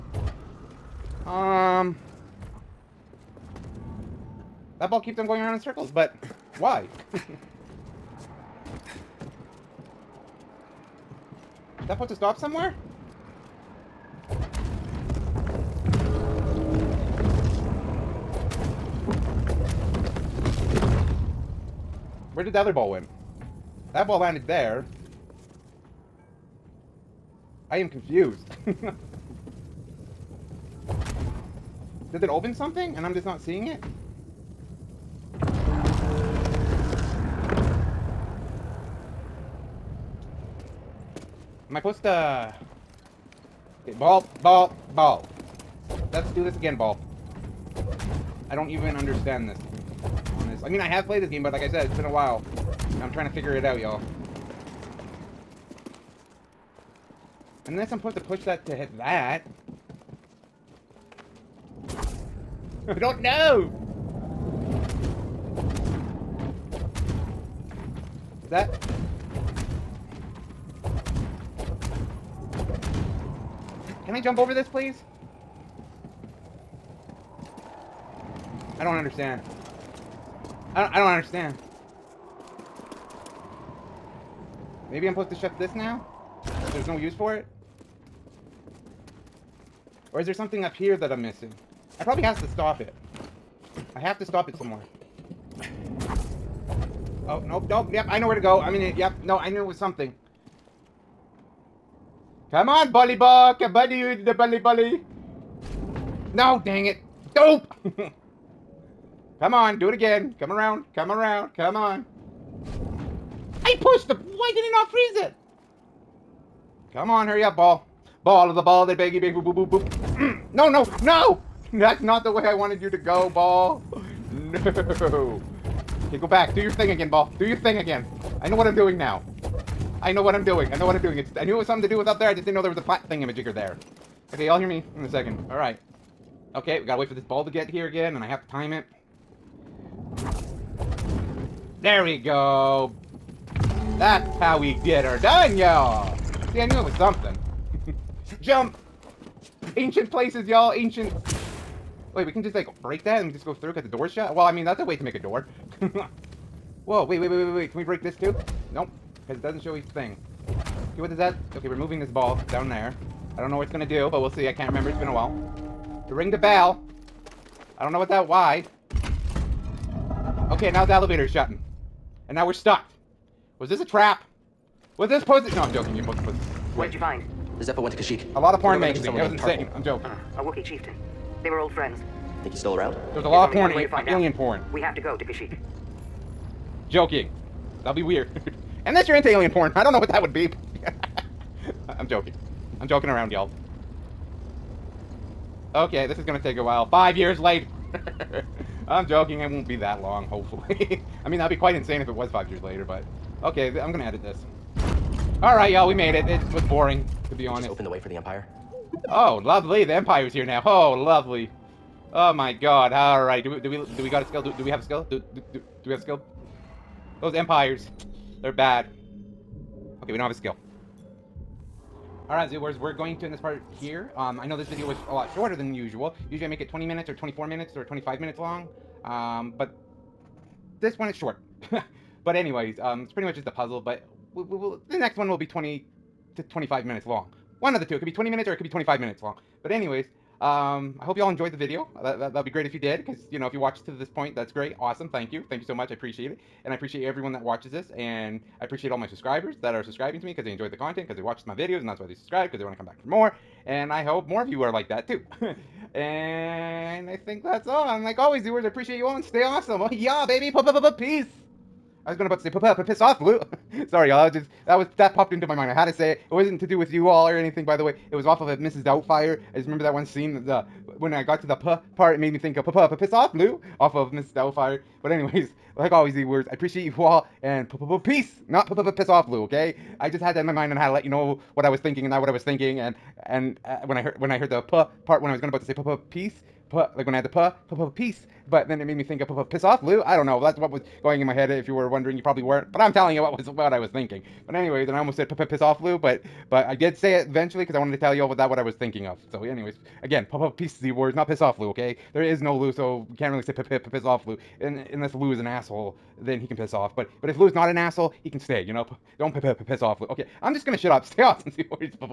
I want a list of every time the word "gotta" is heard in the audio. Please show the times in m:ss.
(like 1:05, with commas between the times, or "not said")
2:16.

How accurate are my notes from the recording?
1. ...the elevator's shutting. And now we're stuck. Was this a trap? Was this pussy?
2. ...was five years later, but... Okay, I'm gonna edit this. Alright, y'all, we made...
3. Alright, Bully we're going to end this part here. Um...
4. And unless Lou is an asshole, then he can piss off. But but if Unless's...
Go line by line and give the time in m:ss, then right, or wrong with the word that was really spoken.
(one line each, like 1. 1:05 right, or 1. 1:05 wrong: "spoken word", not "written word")
1. 2:50 right
2. 3:22 right
3. 3:42 wrong: "Zoo", not "Bully"
4. 5:04 wrong: "Lou", not "Unless".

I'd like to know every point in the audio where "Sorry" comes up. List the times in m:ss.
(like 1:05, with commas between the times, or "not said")
4:23.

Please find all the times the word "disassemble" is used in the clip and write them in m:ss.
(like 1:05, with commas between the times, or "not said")
not said.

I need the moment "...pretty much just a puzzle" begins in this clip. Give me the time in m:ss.
3:53.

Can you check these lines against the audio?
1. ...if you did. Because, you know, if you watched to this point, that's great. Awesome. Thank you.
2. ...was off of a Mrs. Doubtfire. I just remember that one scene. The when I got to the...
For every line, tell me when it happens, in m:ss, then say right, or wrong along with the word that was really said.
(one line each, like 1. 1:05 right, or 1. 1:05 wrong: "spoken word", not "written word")
1. 4:02 right
2. 4:28 right.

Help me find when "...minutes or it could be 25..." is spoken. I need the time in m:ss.
3:58.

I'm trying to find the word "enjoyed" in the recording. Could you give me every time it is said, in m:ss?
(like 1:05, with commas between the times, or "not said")
4:01, 4:10.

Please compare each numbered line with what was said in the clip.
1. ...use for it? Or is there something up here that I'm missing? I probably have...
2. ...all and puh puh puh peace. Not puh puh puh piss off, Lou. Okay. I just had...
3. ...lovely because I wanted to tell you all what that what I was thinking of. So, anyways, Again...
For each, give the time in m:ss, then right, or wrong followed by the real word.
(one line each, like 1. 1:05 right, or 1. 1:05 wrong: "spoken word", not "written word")
1. 1:26 right
2. 4:36 right
3. 4:57 wrong: "eventually", not "lovely".